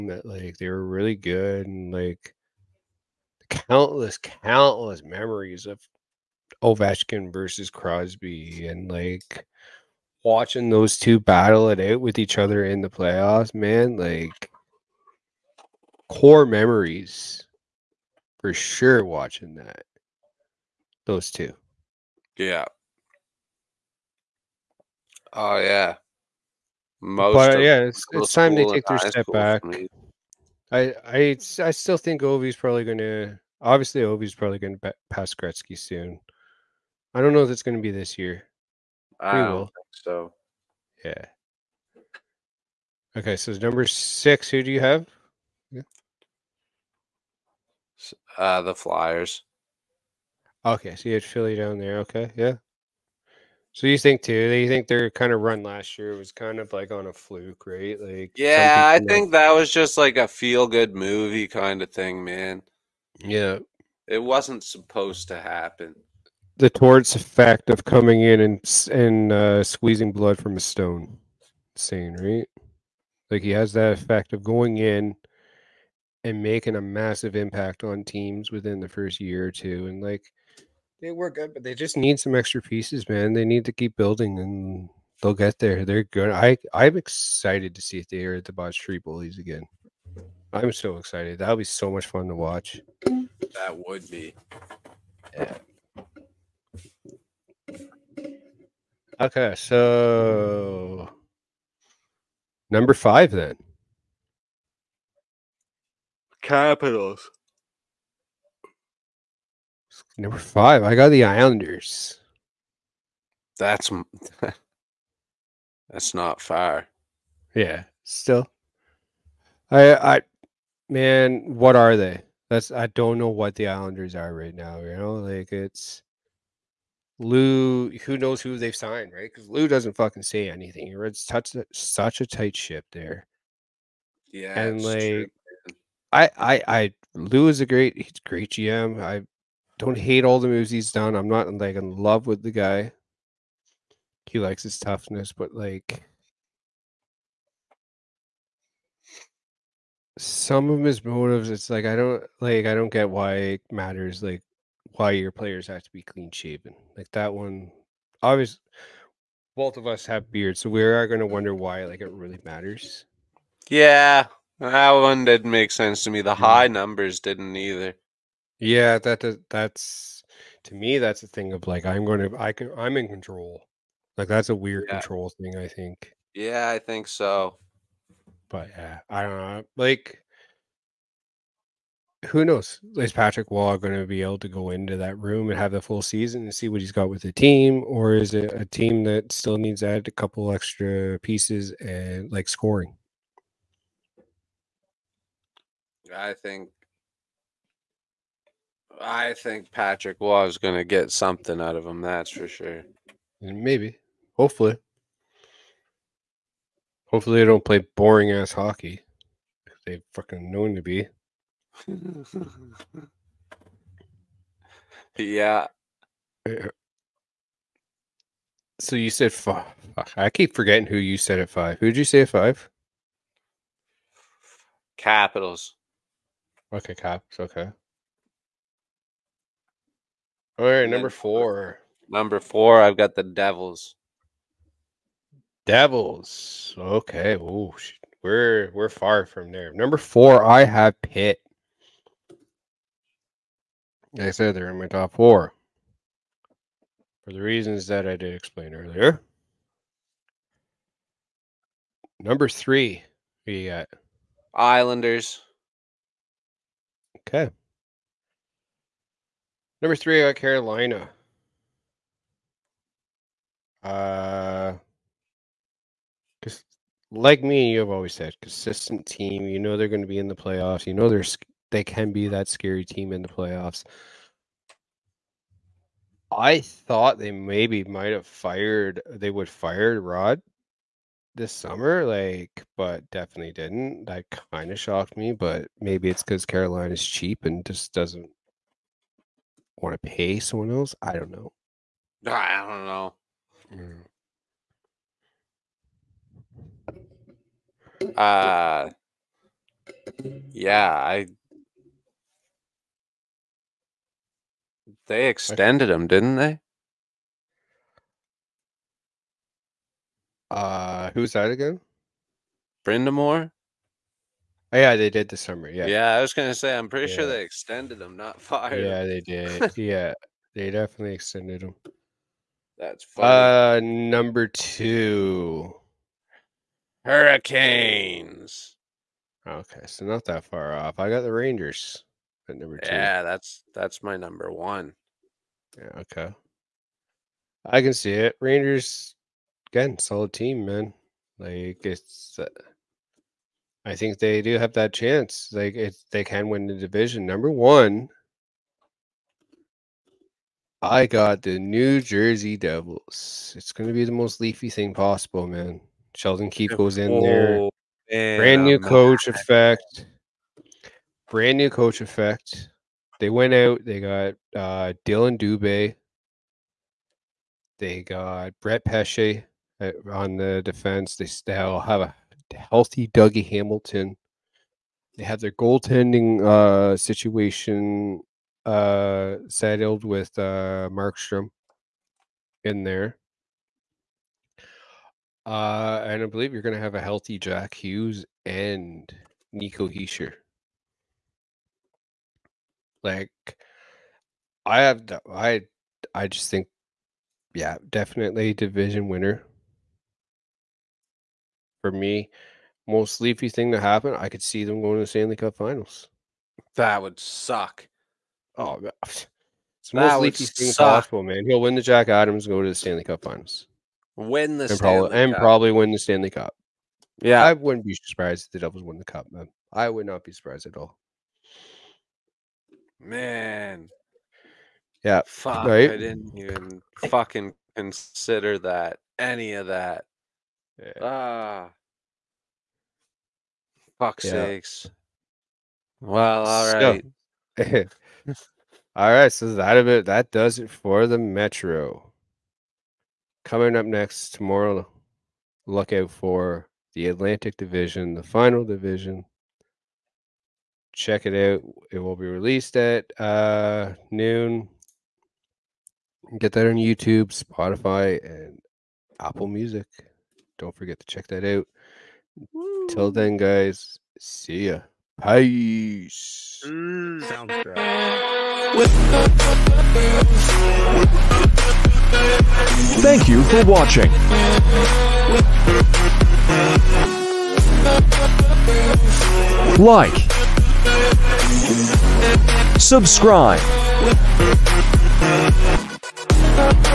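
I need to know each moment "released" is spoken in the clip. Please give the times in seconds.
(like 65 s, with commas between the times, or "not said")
452 s.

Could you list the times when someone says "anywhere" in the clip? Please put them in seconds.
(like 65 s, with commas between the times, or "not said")
not said.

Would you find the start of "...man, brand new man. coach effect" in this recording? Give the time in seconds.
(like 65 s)
358 s.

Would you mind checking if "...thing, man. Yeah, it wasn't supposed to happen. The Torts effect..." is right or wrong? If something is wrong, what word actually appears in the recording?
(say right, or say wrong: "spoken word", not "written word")
right.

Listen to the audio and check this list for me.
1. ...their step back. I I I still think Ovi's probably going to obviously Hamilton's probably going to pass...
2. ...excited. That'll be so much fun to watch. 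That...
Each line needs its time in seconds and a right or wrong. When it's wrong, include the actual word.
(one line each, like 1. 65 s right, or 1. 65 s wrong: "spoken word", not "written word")
1. 28 s wrong: "Ovi", not "Hamilton"
2. 90 s right.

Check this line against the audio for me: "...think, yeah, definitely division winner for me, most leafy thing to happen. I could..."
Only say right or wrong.
right.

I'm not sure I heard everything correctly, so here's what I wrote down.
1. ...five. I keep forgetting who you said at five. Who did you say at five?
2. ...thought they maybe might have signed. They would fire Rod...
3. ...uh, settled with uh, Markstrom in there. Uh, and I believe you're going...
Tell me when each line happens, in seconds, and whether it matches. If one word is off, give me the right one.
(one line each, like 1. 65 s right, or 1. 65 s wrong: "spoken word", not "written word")
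1. 219 s right
2. 276 s wrong: "fired", not "signed"
3. 378 s right.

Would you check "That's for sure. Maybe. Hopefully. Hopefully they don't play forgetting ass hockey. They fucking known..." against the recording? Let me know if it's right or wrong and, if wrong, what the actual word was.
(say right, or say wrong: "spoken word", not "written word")
wrong: "boring", not "forgetting".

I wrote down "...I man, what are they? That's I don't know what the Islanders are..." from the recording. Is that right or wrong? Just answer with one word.
right.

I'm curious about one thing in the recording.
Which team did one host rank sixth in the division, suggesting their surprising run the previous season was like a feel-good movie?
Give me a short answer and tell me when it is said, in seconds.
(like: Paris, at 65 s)
Flyers, at 48 s.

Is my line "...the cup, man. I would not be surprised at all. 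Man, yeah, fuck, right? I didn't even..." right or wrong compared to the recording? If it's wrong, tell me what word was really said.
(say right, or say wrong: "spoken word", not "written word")
right.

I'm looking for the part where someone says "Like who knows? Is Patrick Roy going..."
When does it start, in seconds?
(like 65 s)
179 s.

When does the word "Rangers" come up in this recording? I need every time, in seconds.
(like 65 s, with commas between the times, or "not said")
331 s, 338 s.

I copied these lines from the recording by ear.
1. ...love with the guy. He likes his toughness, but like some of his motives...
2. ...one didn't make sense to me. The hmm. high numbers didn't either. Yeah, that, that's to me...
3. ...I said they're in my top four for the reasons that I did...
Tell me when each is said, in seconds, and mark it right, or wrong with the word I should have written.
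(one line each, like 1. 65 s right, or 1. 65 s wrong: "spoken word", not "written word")
1. 141 s right
2. 164 s right
3. 244 s right.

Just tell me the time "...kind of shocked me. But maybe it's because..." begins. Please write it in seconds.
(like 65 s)
284 s.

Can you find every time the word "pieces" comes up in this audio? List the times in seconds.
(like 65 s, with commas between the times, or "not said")
82 s, 191 s.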